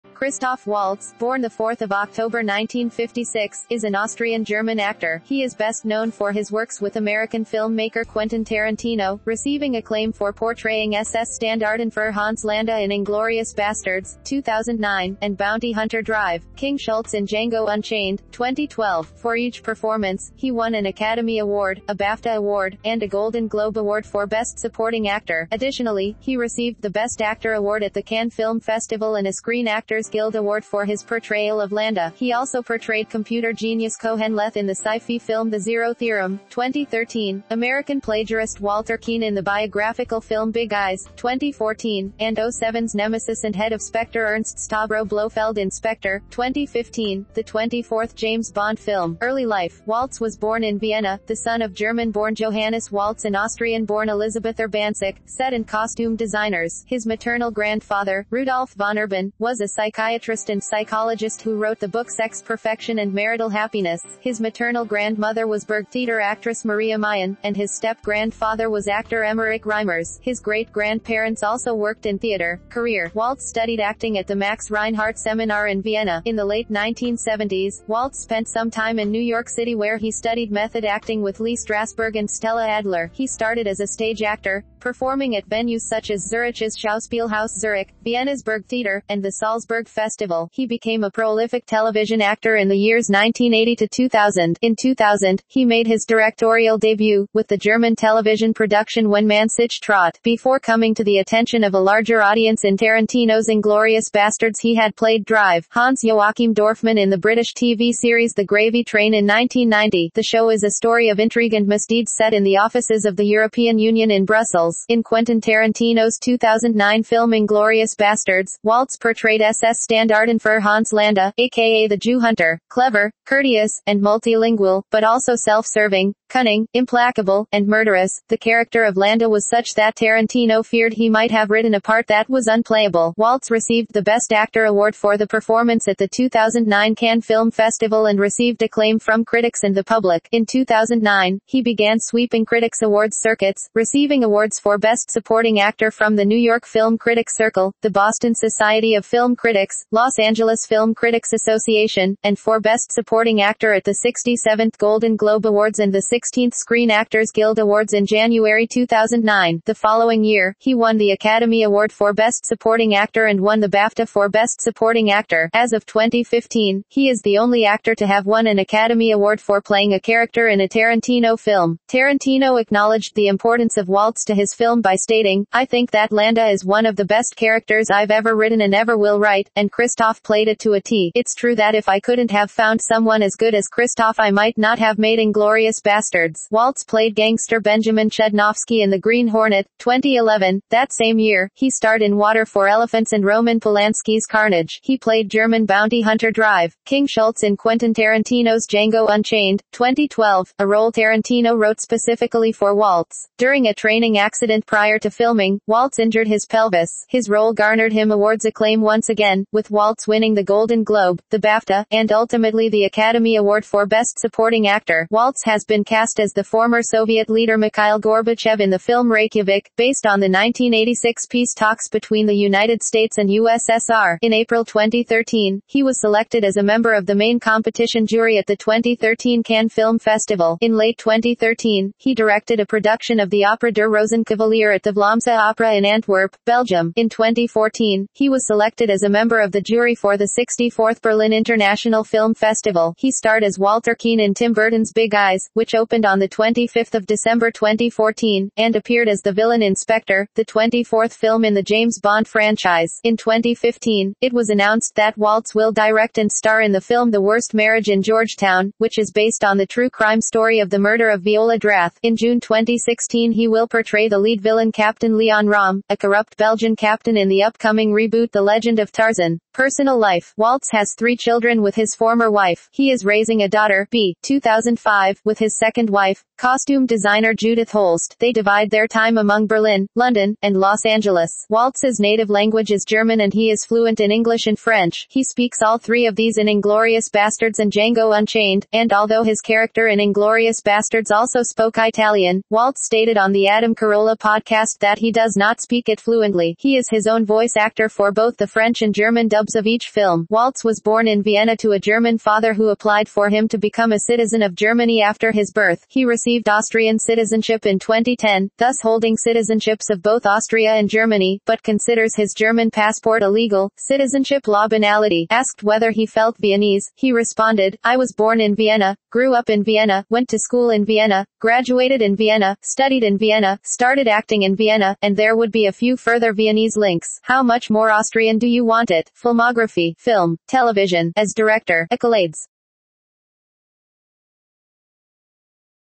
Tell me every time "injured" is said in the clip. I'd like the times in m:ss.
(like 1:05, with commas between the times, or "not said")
3:25.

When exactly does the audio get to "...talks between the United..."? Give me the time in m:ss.
3:41.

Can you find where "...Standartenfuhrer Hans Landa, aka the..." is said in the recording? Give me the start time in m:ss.
1:59.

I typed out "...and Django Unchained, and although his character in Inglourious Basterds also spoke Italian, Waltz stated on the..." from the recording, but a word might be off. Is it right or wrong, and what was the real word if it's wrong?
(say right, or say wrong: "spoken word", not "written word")
right.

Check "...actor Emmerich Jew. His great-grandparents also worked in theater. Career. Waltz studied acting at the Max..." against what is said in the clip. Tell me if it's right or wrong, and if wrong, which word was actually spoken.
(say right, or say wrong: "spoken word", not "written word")
wrong: "Reimers", not "Jew".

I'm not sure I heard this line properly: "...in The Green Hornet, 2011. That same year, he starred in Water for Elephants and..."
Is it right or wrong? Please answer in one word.
right.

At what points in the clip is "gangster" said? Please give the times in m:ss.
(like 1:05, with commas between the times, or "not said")
3:07.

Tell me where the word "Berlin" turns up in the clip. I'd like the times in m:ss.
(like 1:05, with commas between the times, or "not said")
4:01, 4:39.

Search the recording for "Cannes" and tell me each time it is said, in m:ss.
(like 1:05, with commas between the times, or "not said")
0:28, 2:16, 3:49.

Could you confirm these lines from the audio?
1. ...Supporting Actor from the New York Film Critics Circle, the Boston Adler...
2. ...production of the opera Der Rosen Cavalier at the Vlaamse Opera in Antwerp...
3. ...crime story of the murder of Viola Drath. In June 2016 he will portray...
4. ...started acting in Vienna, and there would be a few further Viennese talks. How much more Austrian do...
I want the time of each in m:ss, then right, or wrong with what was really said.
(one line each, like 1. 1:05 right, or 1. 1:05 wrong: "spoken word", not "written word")
1. 2:25 wrong: "Society", not "Adler"
2. 3:52 right
3. 4:19 right
4. 5:23 wrong: "links", not "talks".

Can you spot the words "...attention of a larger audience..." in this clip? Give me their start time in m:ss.
1:41.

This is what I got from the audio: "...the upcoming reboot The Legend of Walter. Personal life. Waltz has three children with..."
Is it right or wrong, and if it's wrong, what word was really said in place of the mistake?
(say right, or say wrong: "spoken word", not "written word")
wrong: "Tarzan", not "Walter".